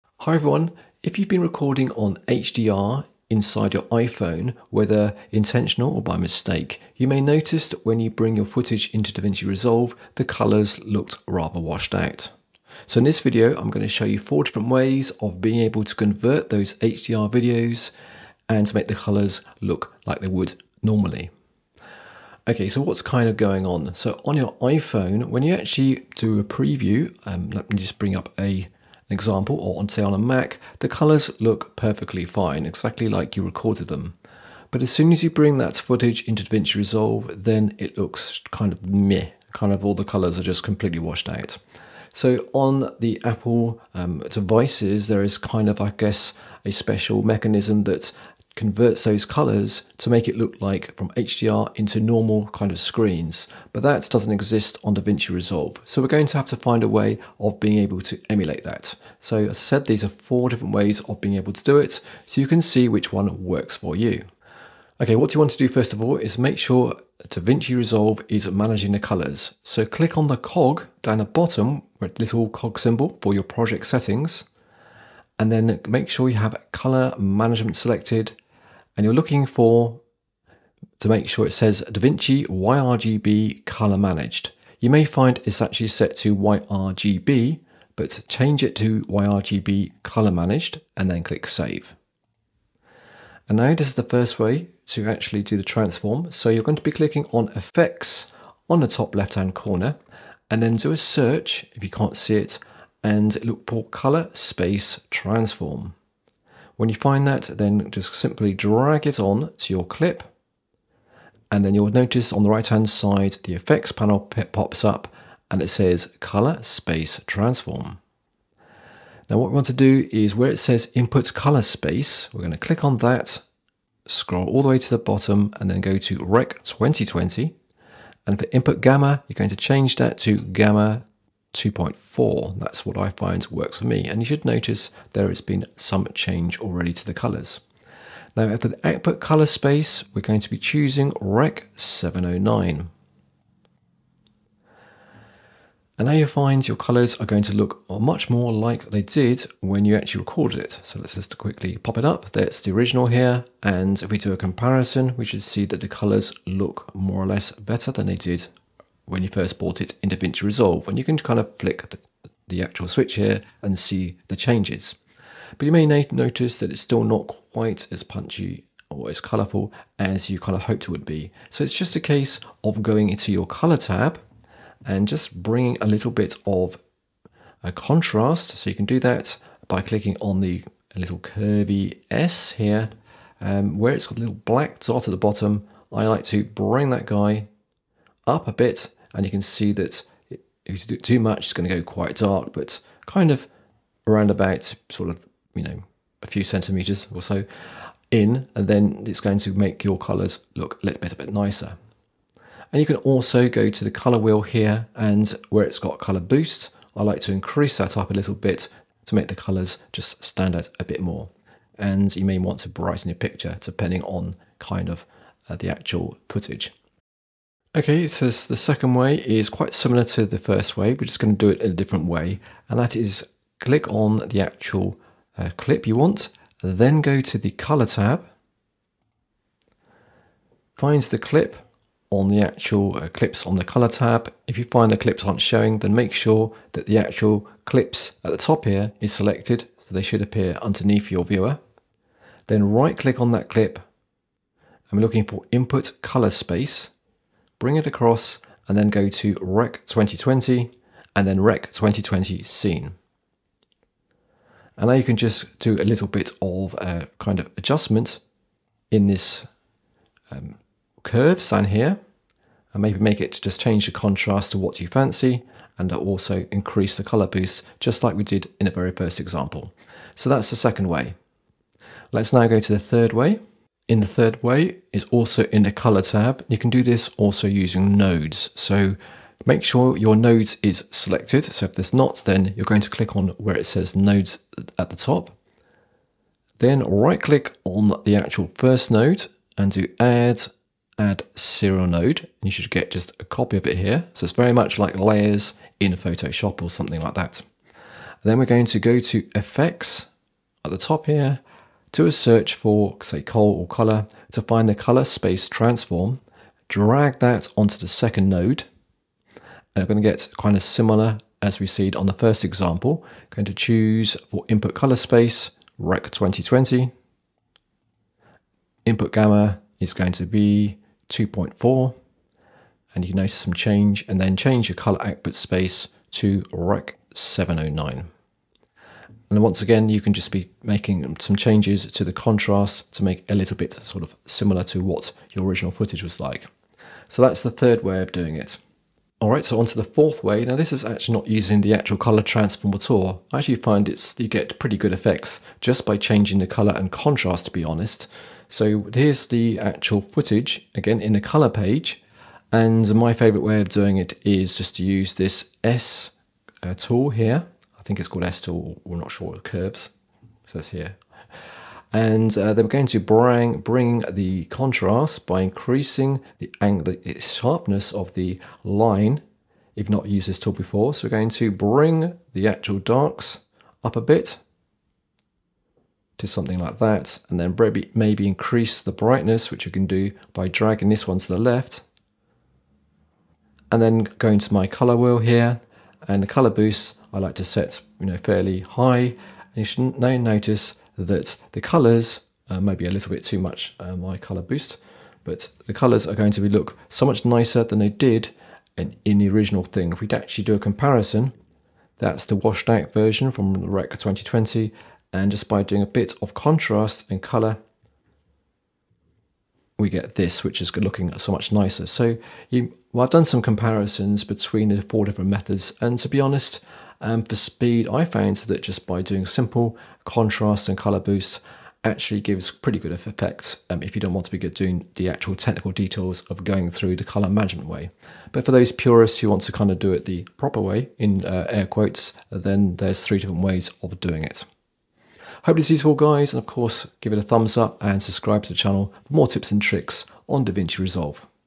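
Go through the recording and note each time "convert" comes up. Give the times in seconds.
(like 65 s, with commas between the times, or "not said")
15 s, 48 s.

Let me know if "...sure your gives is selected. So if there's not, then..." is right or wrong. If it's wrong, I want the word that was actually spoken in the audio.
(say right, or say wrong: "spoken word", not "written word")
wrong: "nodes", not "gives".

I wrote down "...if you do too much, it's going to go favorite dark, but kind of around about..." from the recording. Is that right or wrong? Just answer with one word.
wrong.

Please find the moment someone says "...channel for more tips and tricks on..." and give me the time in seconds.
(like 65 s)
438 s.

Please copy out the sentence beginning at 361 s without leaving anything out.
And uh, they are going to bring, bring the contrast by increasing the, angle, the sharpness of the line.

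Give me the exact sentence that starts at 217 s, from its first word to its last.
Okay, so the second way is quite similar to the first way.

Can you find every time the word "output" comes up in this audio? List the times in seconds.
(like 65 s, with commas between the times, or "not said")
138 s, 325 s.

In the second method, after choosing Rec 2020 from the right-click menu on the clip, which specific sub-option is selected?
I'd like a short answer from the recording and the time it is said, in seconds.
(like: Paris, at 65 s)
Rec 2020 Scene, at 251 s.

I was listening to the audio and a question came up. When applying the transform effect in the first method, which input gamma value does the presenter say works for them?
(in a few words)
Gamma 2.4.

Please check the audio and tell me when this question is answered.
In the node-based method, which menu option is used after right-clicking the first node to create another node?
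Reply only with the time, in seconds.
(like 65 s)
290 s.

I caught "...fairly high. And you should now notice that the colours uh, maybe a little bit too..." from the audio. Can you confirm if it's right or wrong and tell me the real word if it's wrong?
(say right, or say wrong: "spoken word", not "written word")
right.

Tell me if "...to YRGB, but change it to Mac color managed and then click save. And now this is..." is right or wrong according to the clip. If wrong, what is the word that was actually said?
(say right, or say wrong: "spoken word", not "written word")
wrong: "YRGB", not "Mac".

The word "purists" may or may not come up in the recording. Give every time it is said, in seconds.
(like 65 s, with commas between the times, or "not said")
428 s.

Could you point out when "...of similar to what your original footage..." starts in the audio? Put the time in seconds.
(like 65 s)
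334 s.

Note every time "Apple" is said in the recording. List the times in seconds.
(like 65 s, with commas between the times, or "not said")
43 s.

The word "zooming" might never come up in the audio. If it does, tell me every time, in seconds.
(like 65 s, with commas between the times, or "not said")
not said.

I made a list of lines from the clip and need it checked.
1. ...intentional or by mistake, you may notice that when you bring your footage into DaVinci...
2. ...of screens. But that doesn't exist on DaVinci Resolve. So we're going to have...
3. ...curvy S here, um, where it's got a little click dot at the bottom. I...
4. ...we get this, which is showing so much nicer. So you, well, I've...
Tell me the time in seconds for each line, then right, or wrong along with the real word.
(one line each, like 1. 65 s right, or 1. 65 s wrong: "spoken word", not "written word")
1. 5 s right
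2. 52 s right
3. 181 s wrong: "black", not "click"
4. 409 s wrong: "looking", not "showing".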